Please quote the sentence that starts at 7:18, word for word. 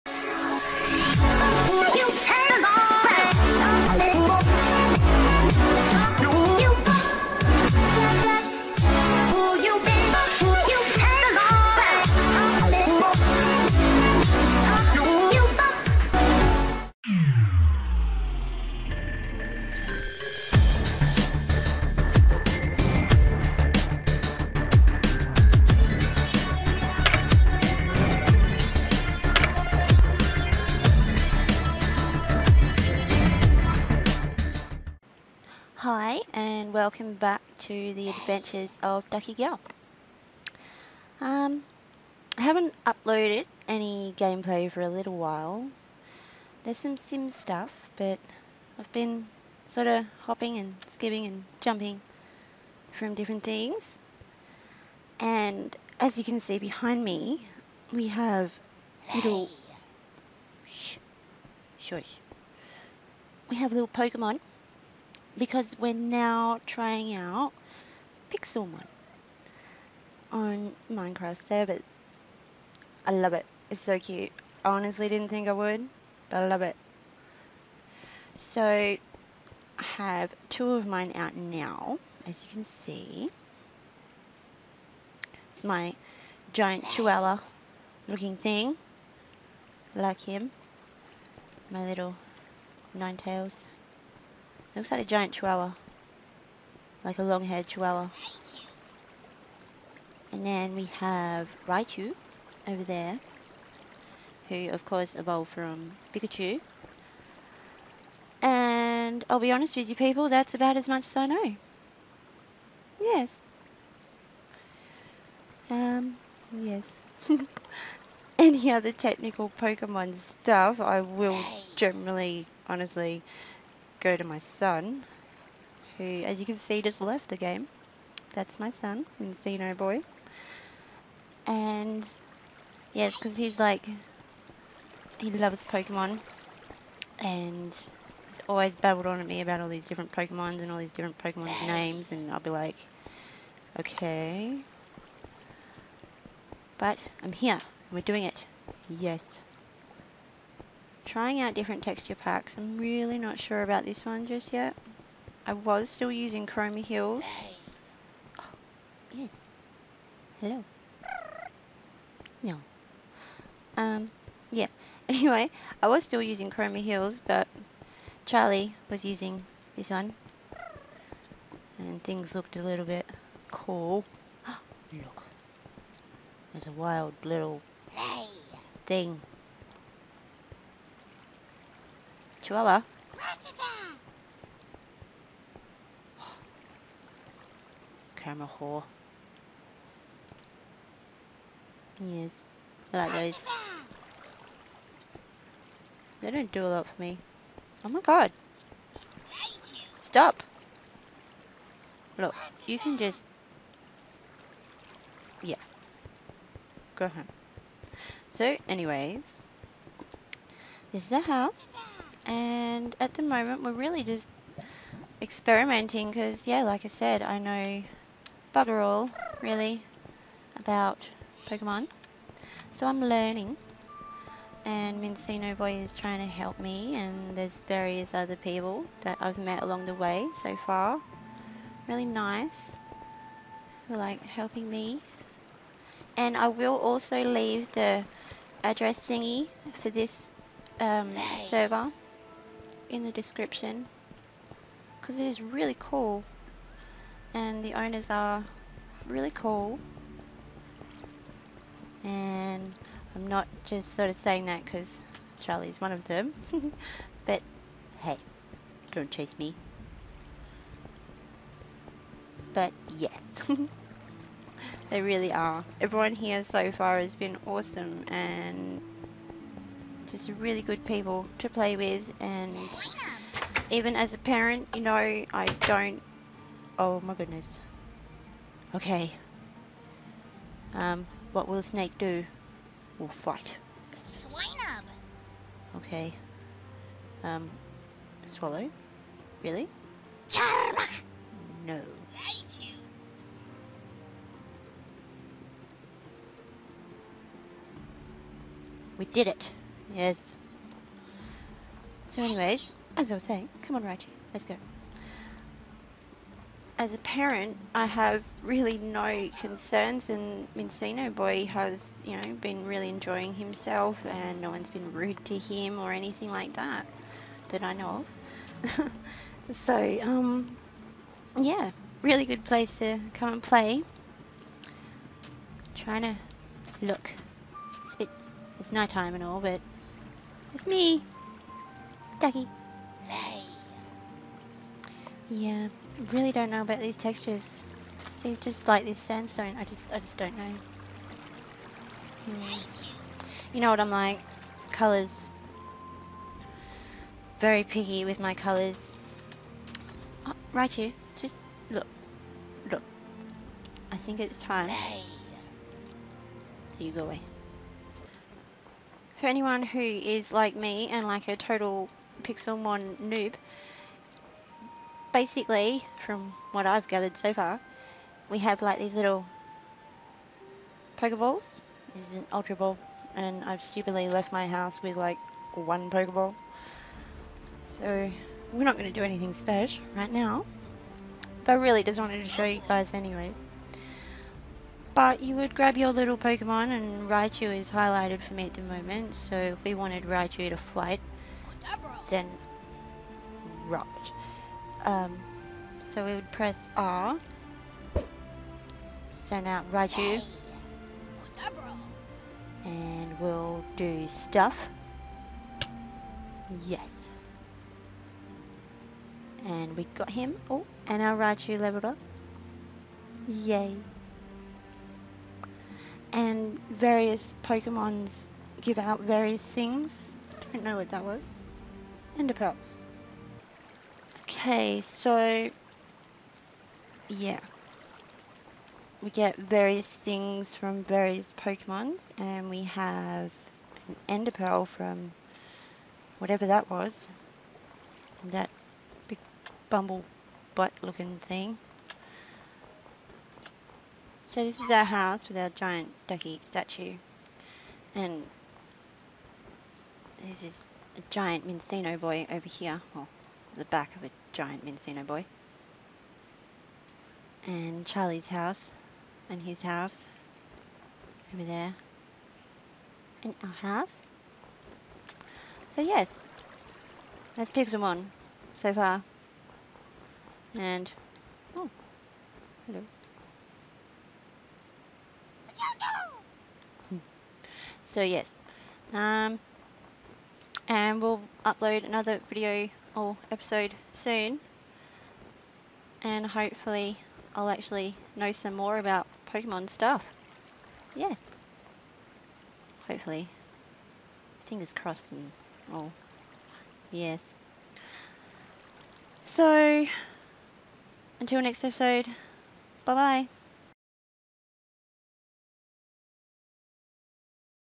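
That big bumble butt looking thing.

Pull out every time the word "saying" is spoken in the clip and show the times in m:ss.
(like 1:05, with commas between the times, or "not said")
4:14, 5:03.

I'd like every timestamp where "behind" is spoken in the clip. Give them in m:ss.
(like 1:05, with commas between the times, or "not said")
0:56.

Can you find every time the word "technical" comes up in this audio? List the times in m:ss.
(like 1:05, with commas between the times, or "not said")
1:58.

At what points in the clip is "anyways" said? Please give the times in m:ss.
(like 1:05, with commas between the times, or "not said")
2:45, 3:28, 5:02, 6:22.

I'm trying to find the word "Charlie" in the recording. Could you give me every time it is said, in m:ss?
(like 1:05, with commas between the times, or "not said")
2:48, 4:15, 7:37.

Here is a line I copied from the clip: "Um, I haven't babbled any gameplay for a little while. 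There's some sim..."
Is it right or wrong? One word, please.
wrong.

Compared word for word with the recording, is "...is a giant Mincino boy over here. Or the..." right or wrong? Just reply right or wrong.
right.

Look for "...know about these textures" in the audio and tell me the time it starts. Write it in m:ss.
5:36.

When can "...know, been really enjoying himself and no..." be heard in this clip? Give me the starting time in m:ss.
5:12.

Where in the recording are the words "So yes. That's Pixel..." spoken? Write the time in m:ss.
7:45.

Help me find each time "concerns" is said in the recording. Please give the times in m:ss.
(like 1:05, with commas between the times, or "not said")
5:09.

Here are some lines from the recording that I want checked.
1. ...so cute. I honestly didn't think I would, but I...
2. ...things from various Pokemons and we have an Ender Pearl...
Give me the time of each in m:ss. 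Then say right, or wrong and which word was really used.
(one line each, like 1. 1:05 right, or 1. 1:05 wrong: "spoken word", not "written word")
1. 1:13 right
2. 7:09 right.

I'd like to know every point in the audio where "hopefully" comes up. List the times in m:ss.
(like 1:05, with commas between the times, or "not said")
8:06, 8:12.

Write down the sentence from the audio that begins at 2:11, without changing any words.
And, yes, because he's like, he loves Pokemon.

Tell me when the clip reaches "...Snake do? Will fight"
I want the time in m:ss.
4:41.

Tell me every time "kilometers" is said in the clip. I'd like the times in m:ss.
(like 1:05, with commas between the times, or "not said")
not said.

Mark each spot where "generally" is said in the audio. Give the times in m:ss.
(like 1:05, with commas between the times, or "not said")
2:01.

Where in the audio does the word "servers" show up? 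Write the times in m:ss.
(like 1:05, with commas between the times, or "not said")
1:11, 4:01.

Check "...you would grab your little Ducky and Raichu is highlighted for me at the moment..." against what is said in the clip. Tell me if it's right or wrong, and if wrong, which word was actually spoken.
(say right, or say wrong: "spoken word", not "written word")
wrong: "Pokemon", not "Ducky".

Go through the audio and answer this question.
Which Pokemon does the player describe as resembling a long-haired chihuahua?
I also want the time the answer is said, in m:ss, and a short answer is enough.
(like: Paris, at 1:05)
Ninetales, at 1:32.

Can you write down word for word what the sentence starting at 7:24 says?
So this is our house with our giant ducky statue.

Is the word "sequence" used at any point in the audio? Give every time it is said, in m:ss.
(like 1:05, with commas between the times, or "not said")
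not said.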